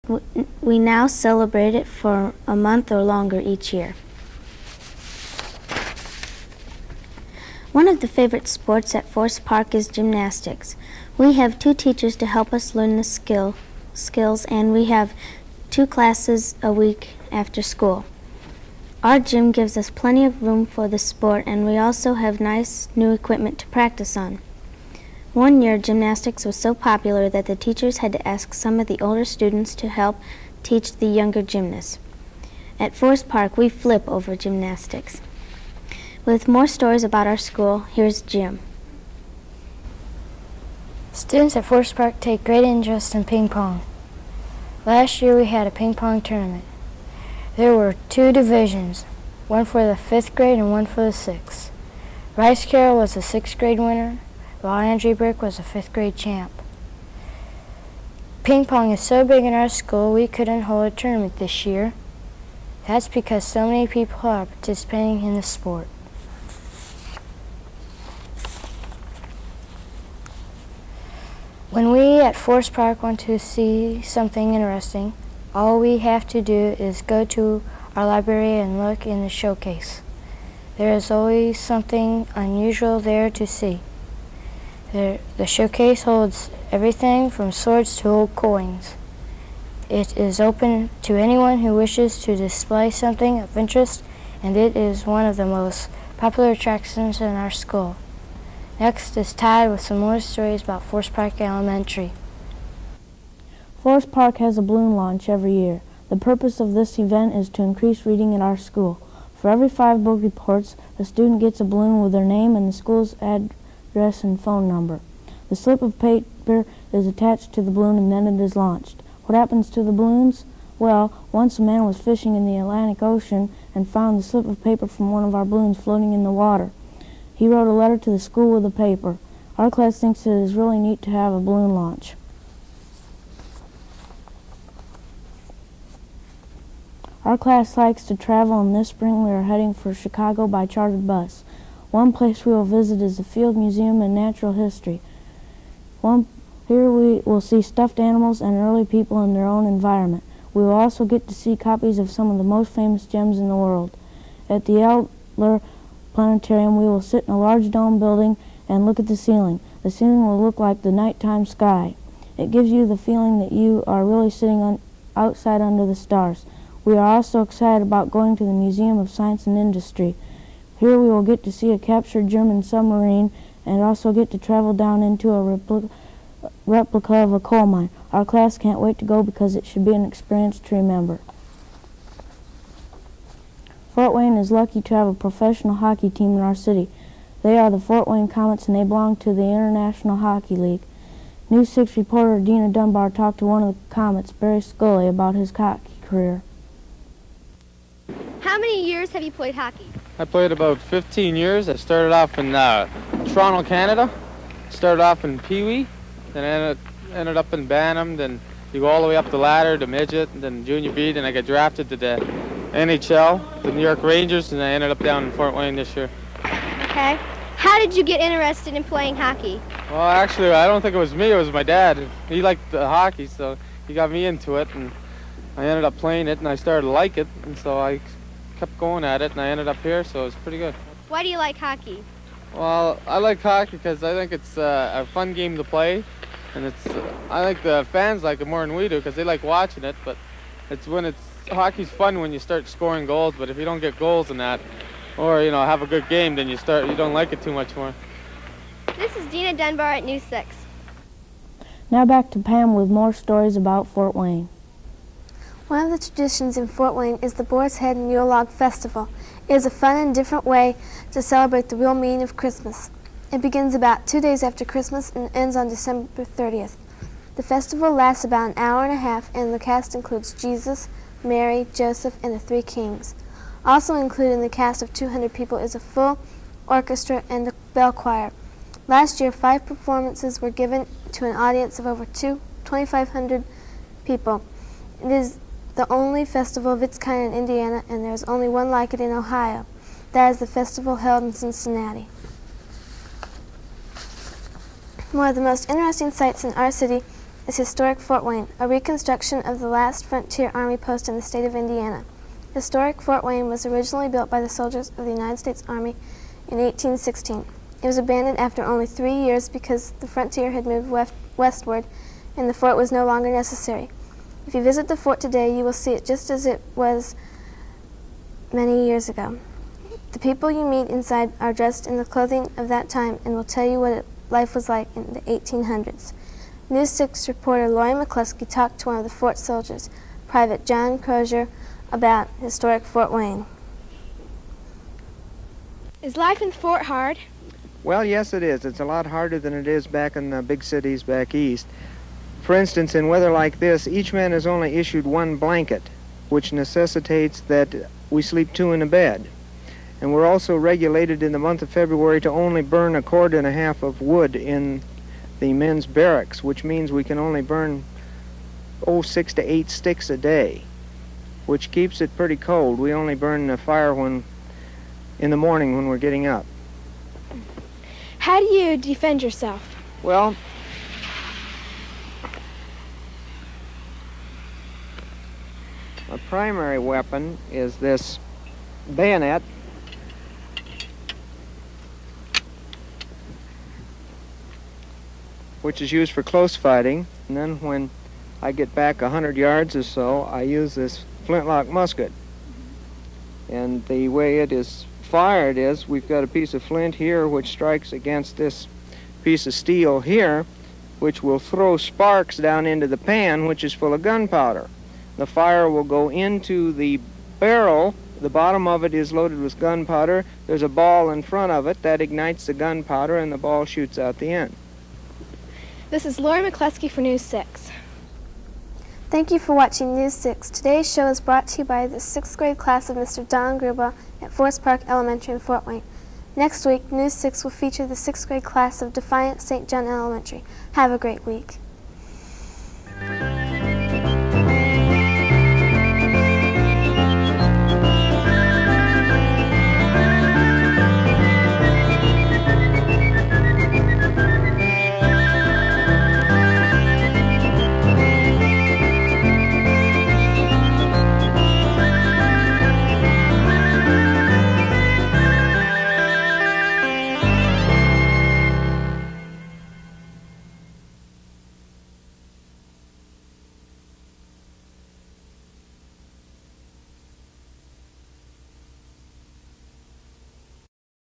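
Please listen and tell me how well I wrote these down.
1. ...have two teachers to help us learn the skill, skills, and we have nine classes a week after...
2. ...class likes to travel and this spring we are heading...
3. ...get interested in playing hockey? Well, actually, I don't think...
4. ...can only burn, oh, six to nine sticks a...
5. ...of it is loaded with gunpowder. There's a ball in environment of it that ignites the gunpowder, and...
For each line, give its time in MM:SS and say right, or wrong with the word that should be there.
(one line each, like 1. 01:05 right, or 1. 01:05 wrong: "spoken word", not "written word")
1. 00:11 wrong: "two", not "nine"
2. 02:17 right
3. 03:38 right
4. 05:57 wrong: "eight", not "nine"
5. 06:48 wrong: "front", not "environment".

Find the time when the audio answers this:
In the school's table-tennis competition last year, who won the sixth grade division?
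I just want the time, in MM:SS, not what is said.
00:52.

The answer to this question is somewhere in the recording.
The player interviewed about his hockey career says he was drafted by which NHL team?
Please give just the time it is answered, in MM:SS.
03:33.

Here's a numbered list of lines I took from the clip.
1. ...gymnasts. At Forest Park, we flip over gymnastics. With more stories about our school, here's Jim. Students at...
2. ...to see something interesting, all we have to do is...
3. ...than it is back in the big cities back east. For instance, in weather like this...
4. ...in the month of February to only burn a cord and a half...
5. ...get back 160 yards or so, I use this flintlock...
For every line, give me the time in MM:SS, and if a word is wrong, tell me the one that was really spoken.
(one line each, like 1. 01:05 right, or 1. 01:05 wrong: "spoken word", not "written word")
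1. 00:31 right
2. 01:13 right
3. 05:39 right
4. 05:51 right
5. 06:28 wrong: "100", not "160".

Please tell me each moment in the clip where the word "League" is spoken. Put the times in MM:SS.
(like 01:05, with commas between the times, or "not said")
03:10.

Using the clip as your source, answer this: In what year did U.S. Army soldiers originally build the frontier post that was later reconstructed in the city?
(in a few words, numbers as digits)
1816.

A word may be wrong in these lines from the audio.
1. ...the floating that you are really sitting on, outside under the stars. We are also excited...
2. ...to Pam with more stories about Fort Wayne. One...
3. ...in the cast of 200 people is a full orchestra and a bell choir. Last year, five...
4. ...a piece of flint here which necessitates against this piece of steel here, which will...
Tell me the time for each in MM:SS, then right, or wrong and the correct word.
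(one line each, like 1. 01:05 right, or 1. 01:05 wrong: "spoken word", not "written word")
1. 02:42 wrong: "feeling", not "floating"
2. 04:12 right
3. 04:34 right
4. 06:36 wrong: "strikes", not "necessitates".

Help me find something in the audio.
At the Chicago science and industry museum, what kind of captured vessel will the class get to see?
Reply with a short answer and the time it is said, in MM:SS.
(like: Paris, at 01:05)
German submarine, at 02:52.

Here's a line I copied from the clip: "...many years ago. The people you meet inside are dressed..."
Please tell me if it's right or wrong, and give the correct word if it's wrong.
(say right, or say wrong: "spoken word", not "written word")
right.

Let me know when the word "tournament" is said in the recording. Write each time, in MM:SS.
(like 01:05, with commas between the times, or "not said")
00:46, 01:00.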